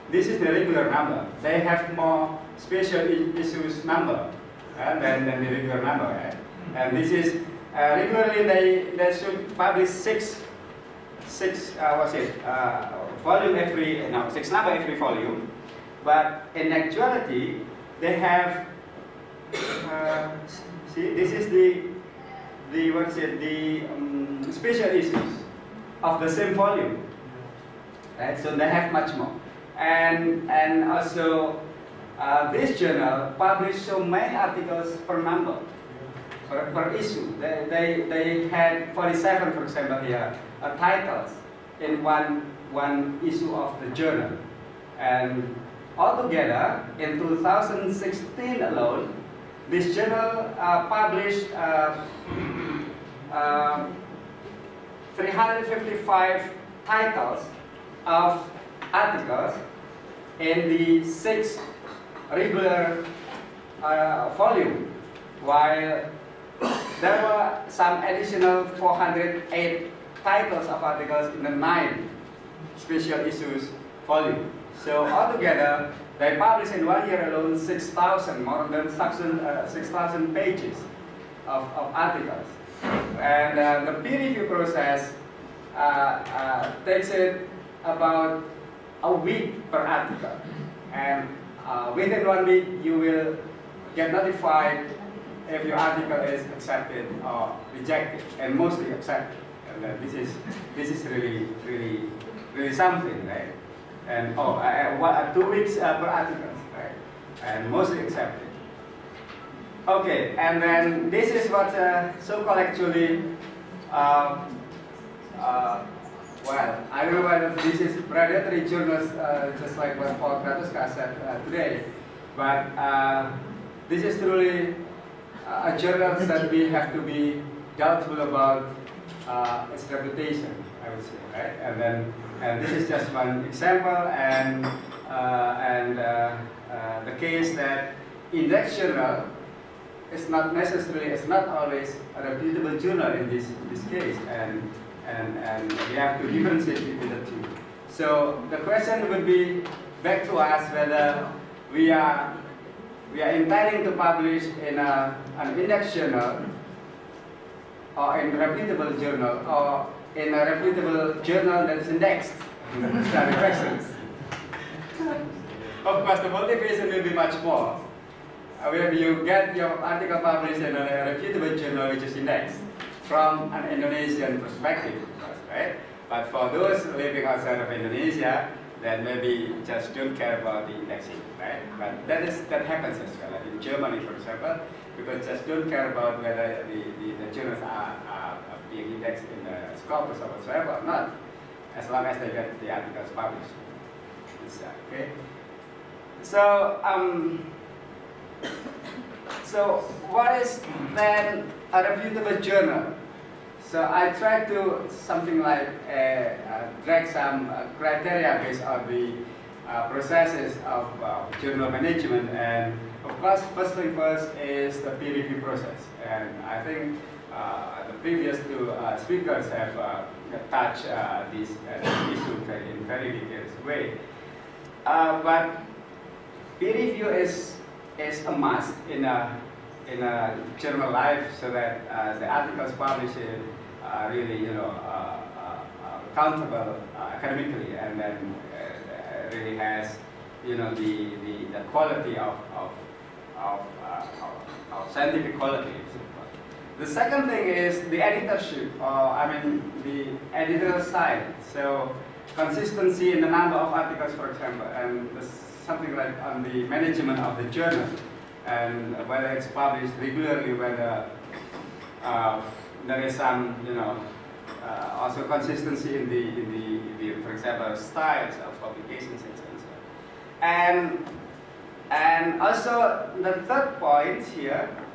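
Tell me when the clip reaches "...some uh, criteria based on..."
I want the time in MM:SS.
03:27.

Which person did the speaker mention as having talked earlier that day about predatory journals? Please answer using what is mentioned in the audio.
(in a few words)
Paul Kratoska.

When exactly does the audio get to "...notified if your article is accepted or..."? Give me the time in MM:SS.
01:34.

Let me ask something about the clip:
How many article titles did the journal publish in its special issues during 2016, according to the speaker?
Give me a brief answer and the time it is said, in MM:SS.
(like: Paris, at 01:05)
408, at 01:08.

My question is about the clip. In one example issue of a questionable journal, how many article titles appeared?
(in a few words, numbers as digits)
47.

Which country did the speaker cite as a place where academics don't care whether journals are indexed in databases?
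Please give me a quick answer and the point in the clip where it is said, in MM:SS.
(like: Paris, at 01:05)
Germany, at 03:03.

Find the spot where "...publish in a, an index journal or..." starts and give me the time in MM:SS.
02:33.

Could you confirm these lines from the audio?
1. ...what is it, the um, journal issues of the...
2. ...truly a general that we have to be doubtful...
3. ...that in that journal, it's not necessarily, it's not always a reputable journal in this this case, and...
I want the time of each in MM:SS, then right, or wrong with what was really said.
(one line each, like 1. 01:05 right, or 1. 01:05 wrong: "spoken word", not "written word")
1. 00:22 wrong: "special", not "journal"
2. 02:04 wrong: "journal", not "general"
3. 02:17 right.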